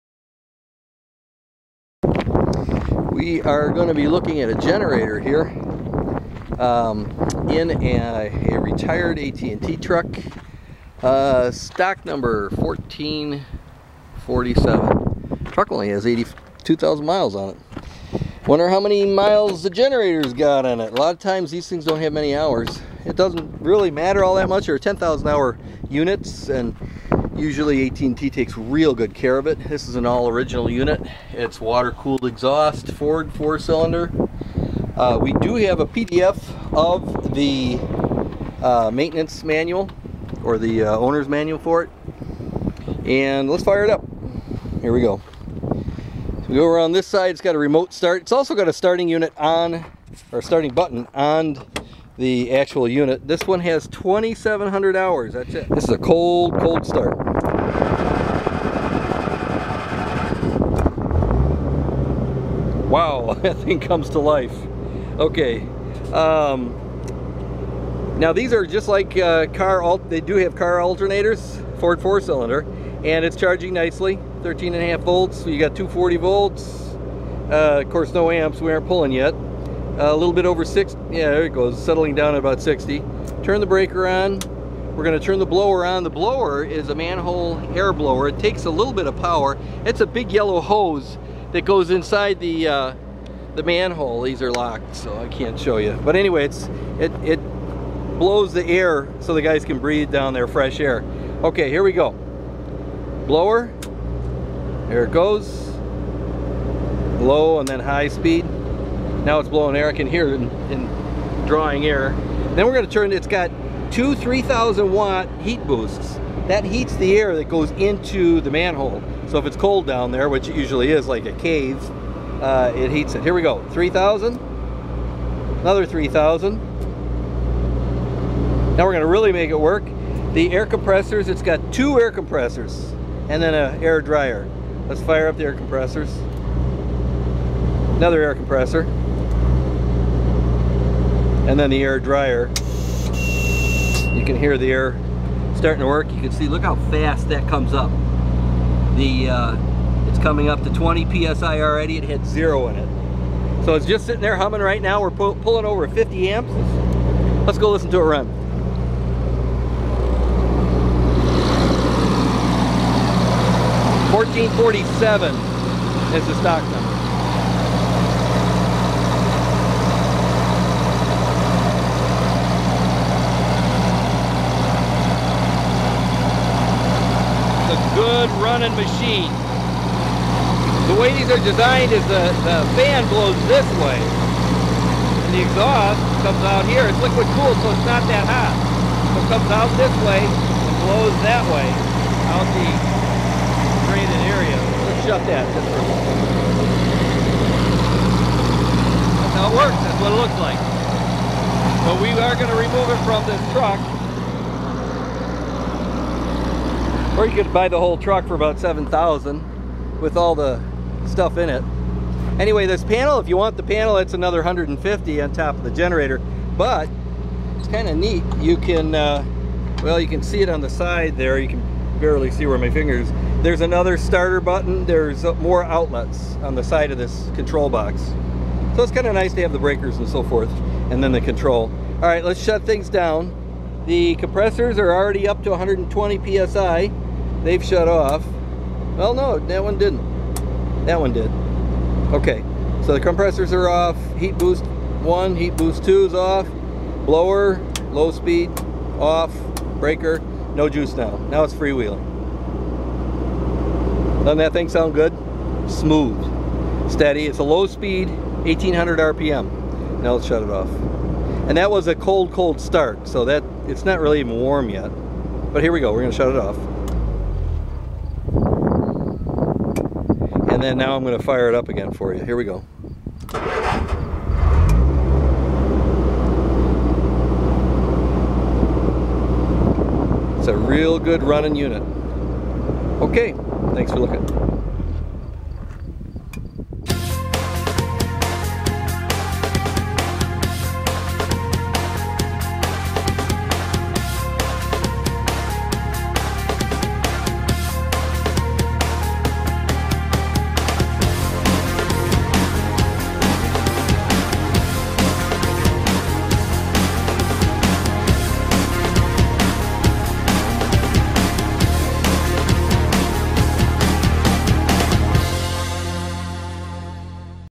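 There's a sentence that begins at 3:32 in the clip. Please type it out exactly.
Anyway, this panel, if you want the panel, it's another 150 on top of the generator.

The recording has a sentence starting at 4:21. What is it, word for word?
And that was a cold, cold start, so that it's not really even warm yet.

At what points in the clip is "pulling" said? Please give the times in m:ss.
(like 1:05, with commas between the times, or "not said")
1:18, 2:35.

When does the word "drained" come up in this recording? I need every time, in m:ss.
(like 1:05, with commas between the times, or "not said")
3:13.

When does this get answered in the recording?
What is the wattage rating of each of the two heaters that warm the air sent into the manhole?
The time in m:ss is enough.
1:54.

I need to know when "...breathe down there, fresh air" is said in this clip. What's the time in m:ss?
1:39.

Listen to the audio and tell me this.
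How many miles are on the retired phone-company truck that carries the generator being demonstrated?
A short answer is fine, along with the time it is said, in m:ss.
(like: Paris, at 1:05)
82,000, at 0:16.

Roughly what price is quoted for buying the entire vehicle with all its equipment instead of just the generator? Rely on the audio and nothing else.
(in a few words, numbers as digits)
$7,000.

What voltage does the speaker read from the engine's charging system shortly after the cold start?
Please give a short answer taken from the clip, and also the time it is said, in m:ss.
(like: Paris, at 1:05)
13.5 volts, at 1:14.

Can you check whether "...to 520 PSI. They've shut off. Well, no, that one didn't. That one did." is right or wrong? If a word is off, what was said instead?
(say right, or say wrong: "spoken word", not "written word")
wrong: "120", not "520".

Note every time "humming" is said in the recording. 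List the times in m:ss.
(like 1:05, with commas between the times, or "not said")
2:34.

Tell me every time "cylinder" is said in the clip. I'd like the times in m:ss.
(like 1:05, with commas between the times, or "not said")
0:33, 1:12.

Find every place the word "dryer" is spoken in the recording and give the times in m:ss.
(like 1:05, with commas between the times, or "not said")
2:14, 2:21.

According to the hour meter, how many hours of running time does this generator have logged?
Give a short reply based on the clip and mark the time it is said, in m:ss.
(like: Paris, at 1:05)
2,700, at 0:53.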